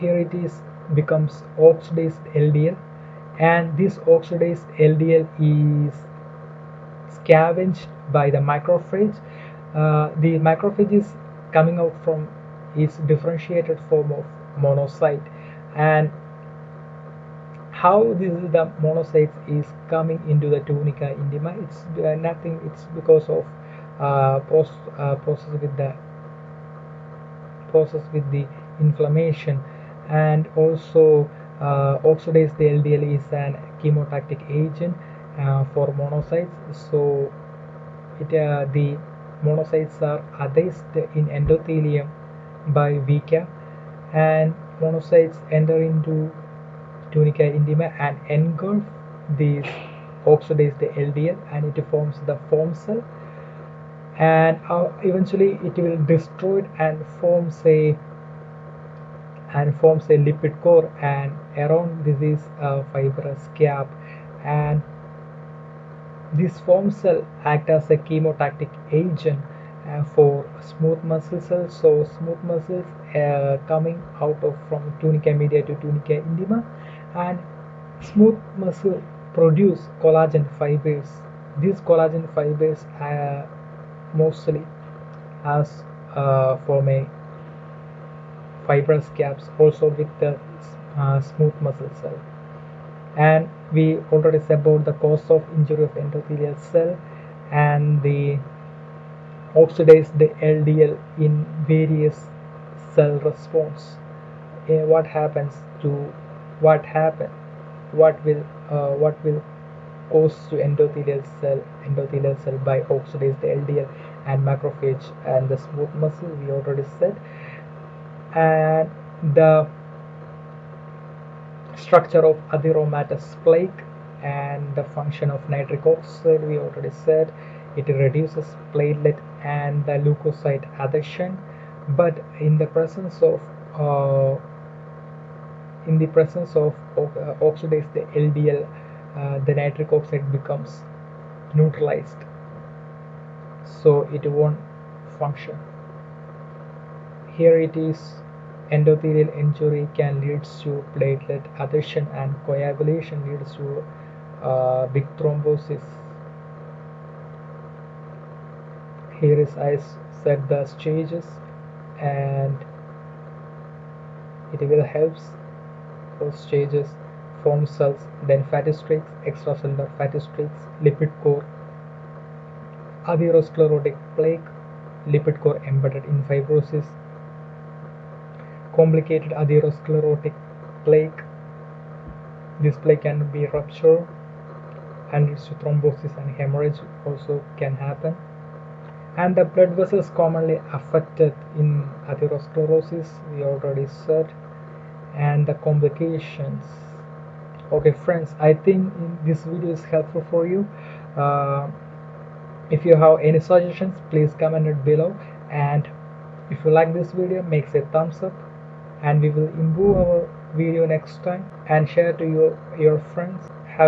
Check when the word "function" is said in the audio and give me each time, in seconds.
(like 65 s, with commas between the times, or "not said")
124 s, 145 s.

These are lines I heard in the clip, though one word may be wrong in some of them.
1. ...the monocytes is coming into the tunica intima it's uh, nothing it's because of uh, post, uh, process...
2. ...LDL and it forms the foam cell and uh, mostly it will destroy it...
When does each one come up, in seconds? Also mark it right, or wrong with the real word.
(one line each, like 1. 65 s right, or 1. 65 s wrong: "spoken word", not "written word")
1. 18 s right
2. 51 s wrong: "eventually", not "mostly".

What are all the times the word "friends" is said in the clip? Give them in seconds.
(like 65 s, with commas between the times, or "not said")
197 s, 213 s.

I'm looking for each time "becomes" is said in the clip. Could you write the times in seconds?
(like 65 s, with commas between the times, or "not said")
0 s, 140 s.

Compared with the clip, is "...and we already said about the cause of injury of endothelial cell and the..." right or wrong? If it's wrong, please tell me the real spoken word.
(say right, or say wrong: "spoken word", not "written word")
right.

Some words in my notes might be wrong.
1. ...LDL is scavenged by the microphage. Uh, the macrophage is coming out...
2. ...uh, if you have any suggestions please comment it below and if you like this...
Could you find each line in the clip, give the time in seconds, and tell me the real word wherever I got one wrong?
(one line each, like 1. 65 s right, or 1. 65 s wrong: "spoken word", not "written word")
1. 4 s wrong: "microphage", not "macrophage"
2. 201 s right.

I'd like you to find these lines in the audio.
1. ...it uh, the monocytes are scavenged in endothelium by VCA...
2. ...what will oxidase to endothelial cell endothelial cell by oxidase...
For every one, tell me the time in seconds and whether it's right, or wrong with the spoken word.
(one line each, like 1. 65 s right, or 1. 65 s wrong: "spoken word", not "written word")
1. 38 s wrong: "adhesed", not "scavenged"
2. 109 s wrong: "cause", not "oxidase".